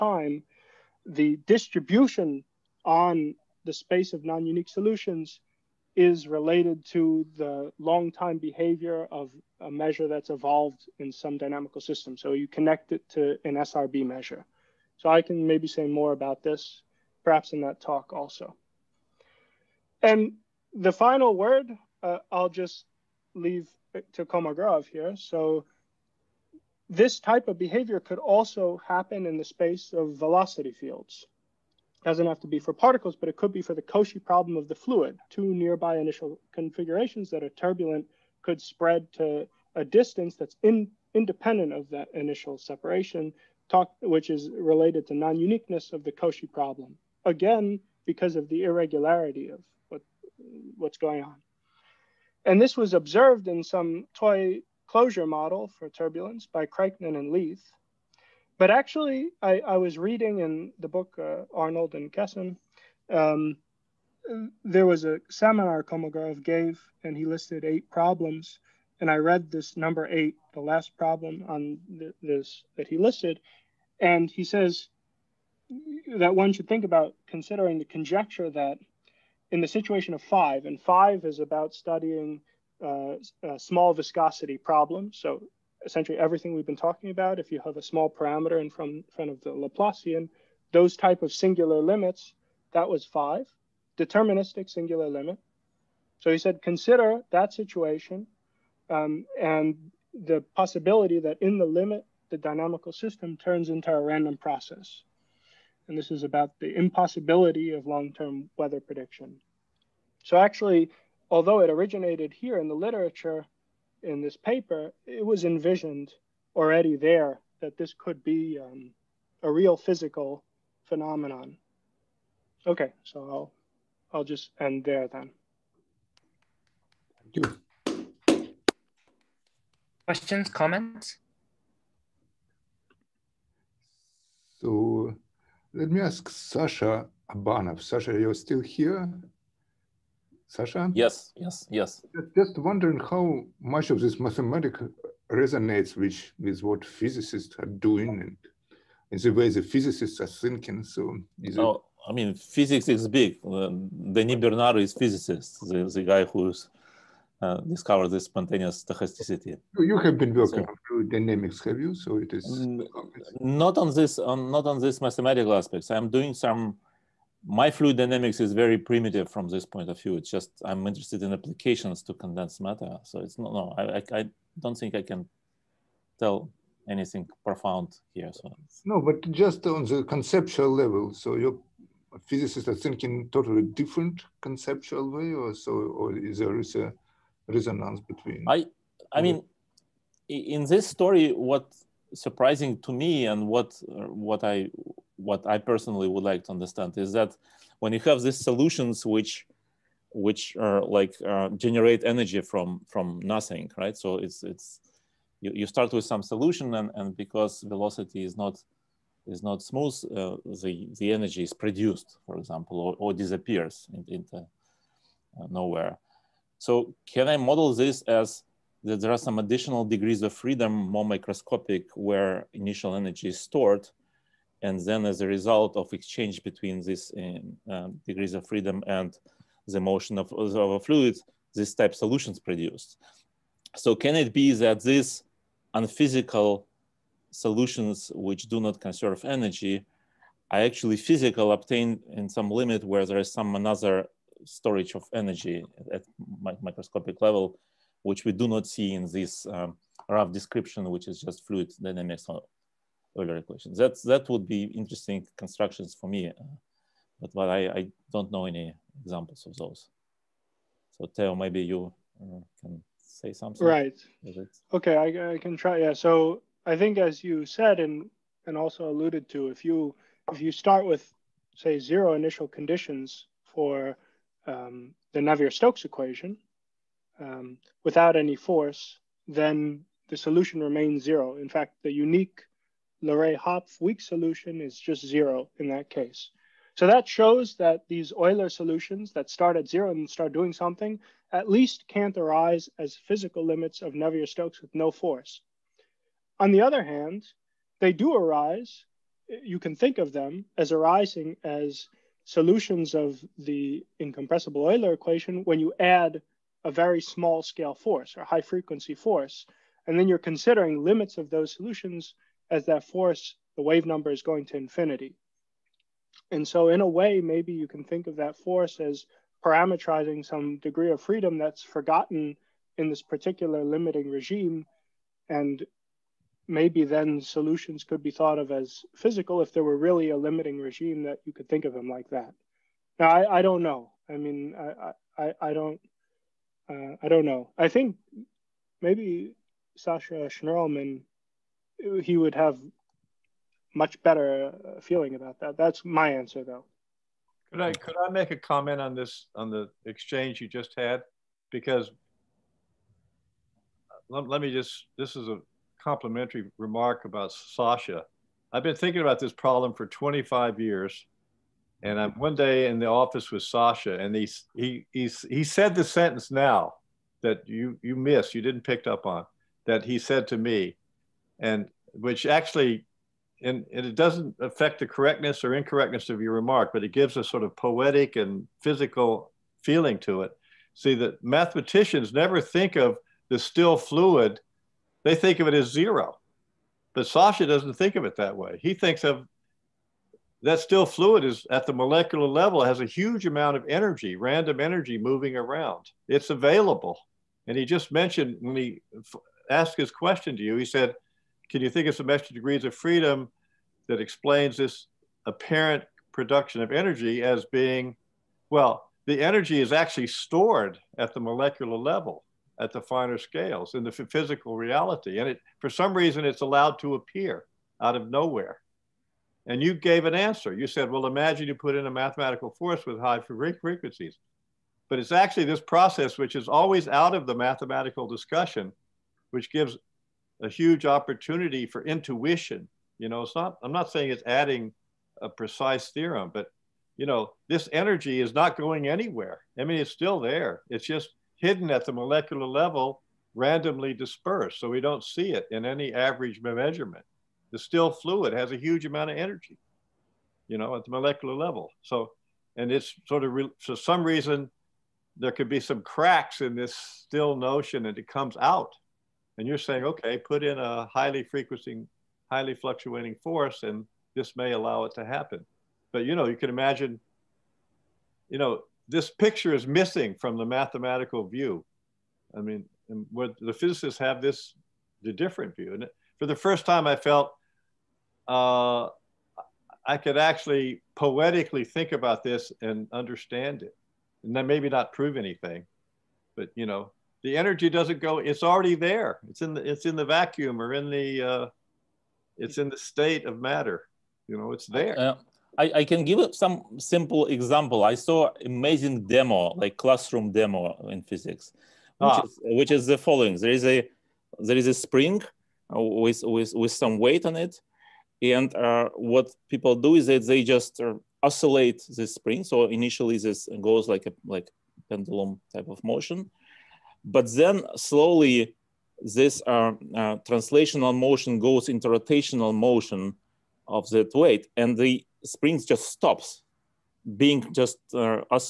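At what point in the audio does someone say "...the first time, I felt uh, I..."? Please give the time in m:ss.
7:56.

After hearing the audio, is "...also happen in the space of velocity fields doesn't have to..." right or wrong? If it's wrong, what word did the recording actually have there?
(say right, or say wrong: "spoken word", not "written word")
right.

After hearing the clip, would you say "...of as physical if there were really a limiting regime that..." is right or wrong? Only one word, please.
right.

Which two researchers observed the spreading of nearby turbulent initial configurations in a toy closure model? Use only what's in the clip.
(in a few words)
Kraichnan and Leith.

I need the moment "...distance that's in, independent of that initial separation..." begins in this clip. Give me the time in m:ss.
0:39.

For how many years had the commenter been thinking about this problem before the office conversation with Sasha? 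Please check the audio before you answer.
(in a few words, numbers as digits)
25.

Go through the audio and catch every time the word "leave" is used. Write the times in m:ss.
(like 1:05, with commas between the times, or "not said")
0:23.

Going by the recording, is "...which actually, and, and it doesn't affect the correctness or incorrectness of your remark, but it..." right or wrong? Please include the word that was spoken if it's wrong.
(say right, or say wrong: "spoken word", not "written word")
right.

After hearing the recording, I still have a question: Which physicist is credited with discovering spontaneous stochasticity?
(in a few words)
Denis Bernard.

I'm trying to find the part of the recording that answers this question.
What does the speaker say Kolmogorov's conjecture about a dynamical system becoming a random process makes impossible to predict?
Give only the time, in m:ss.
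1:47.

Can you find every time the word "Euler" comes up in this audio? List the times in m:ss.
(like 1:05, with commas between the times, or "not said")
4:13, 4:48, 5:04.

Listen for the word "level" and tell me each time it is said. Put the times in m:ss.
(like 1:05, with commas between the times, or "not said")
3:00, 4:07, 6:32, 6:51, 7:22, 7:31.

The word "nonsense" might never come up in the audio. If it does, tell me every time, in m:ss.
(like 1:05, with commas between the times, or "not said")
not said.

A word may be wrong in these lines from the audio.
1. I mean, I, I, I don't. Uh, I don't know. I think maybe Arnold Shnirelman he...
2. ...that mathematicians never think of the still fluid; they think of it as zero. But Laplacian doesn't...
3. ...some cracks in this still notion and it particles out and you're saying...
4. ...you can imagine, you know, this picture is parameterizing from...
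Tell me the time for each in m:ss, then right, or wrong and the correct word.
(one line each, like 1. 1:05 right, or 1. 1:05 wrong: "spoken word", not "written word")
1. 5:34 wrong: "Sasha", not "Arnold"
2. 6:20 wrong: "Sasha", not "Laplacian"
3. 7:35 wrong: "comes", not "particles"
4. 7:46 wrong: "missing", not "parameterizing".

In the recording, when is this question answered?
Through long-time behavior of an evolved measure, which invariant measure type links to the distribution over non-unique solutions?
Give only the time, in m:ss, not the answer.
0:13.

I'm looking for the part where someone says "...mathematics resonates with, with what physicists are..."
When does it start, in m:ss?
2:24.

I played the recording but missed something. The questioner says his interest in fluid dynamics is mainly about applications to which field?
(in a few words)
condensed matter.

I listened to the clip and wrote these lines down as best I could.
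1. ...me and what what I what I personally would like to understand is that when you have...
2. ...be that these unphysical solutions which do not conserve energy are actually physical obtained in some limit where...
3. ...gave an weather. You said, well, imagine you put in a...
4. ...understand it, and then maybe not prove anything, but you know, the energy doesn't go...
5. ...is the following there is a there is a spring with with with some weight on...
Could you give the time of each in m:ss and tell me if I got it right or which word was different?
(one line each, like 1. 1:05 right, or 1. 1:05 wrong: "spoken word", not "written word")
1. 3:12 right
2. 3:54 right
3. 6:59 wrong: "answer", not "weather"
4. 8:02 right
5. 8:22 right.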